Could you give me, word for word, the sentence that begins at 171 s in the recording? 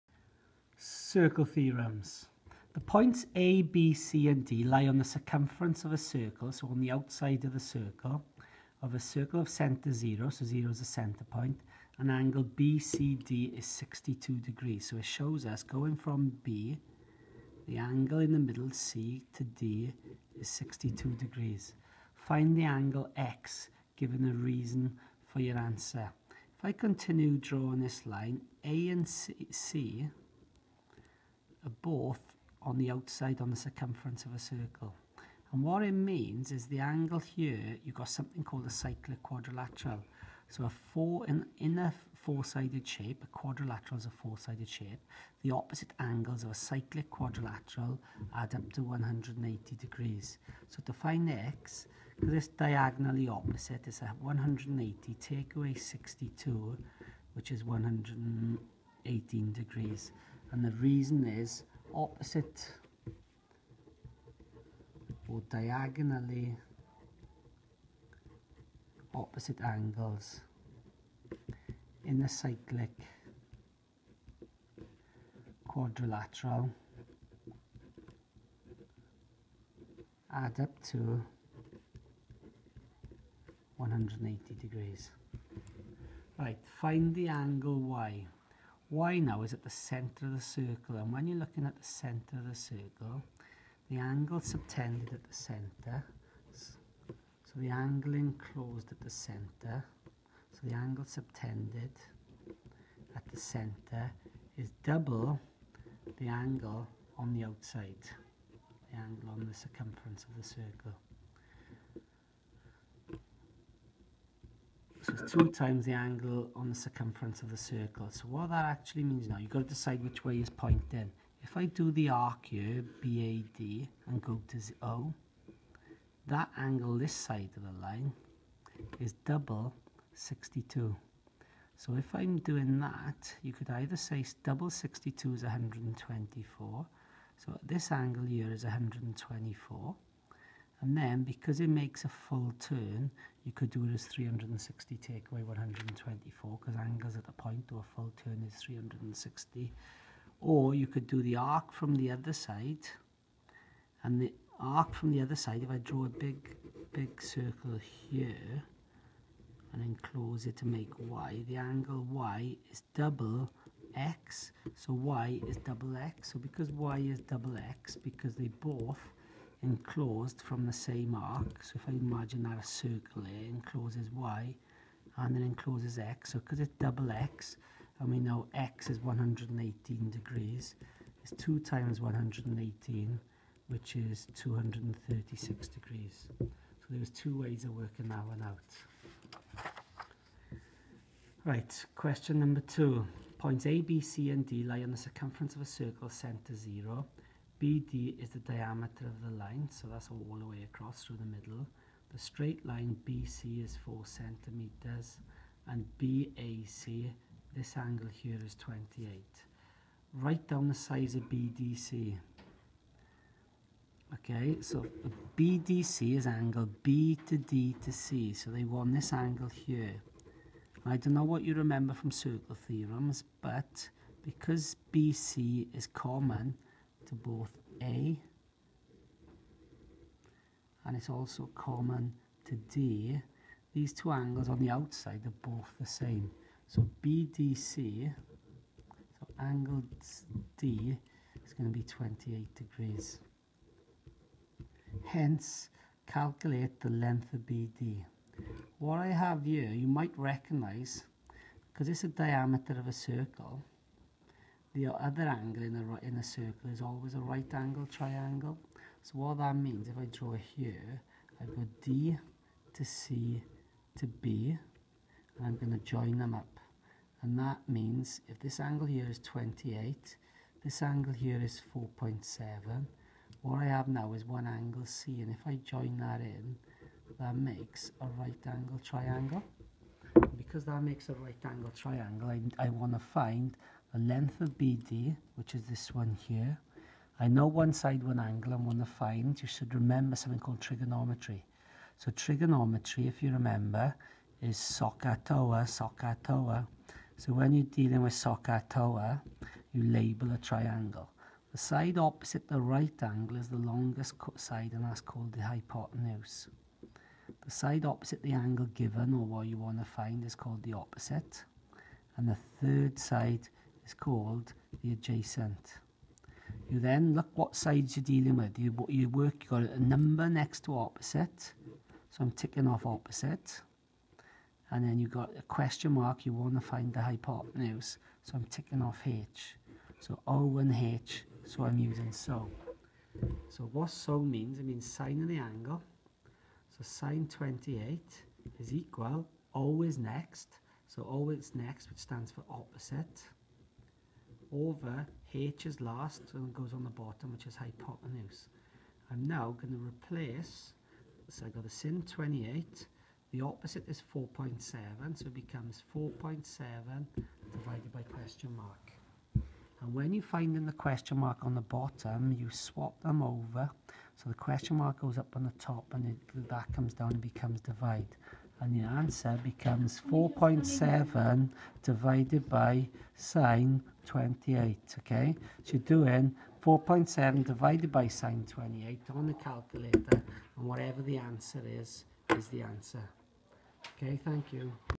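So if I imagine that a circle here encloses y and then encloses x.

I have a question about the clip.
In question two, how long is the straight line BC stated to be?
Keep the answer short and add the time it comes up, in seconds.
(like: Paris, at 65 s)
4 centimeters, at 203 s.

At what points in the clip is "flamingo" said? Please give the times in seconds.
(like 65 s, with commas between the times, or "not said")
not said.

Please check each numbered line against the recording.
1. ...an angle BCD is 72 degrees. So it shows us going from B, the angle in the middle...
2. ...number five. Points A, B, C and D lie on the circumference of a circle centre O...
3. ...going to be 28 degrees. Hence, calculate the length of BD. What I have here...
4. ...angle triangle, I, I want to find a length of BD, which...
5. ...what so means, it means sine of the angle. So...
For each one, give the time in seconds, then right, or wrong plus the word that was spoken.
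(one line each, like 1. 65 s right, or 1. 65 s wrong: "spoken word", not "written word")
1. 11 s wrong: "62", not "72"
2. 192 s wrong: "two", not "five"
3. 241 s right
4. 281 s right
5. 333 s right.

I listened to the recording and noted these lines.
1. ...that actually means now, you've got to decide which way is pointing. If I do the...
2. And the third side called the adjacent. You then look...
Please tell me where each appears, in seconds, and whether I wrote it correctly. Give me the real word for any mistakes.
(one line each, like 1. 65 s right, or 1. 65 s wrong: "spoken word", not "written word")
1. 118 s right
2. 312 s right.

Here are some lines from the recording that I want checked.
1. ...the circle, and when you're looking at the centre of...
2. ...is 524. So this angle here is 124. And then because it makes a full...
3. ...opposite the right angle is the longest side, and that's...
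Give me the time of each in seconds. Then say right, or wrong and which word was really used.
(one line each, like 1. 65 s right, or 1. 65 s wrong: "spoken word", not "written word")
1. 90 s right
2. 135 s wrong: "124", not "524"
3. 301 s right.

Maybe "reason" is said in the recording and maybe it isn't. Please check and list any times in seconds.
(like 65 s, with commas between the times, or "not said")
24 s, 60 s.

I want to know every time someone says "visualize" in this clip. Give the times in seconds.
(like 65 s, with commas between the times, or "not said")
not said.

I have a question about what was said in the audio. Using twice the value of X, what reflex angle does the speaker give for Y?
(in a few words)
236 degrees.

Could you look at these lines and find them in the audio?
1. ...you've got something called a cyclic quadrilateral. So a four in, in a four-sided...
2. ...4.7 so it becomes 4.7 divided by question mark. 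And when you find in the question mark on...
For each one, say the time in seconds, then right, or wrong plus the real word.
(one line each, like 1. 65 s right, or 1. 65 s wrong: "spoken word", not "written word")
1. 37 s right
2. 354 s right.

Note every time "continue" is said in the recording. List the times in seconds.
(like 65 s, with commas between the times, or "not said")
26 s.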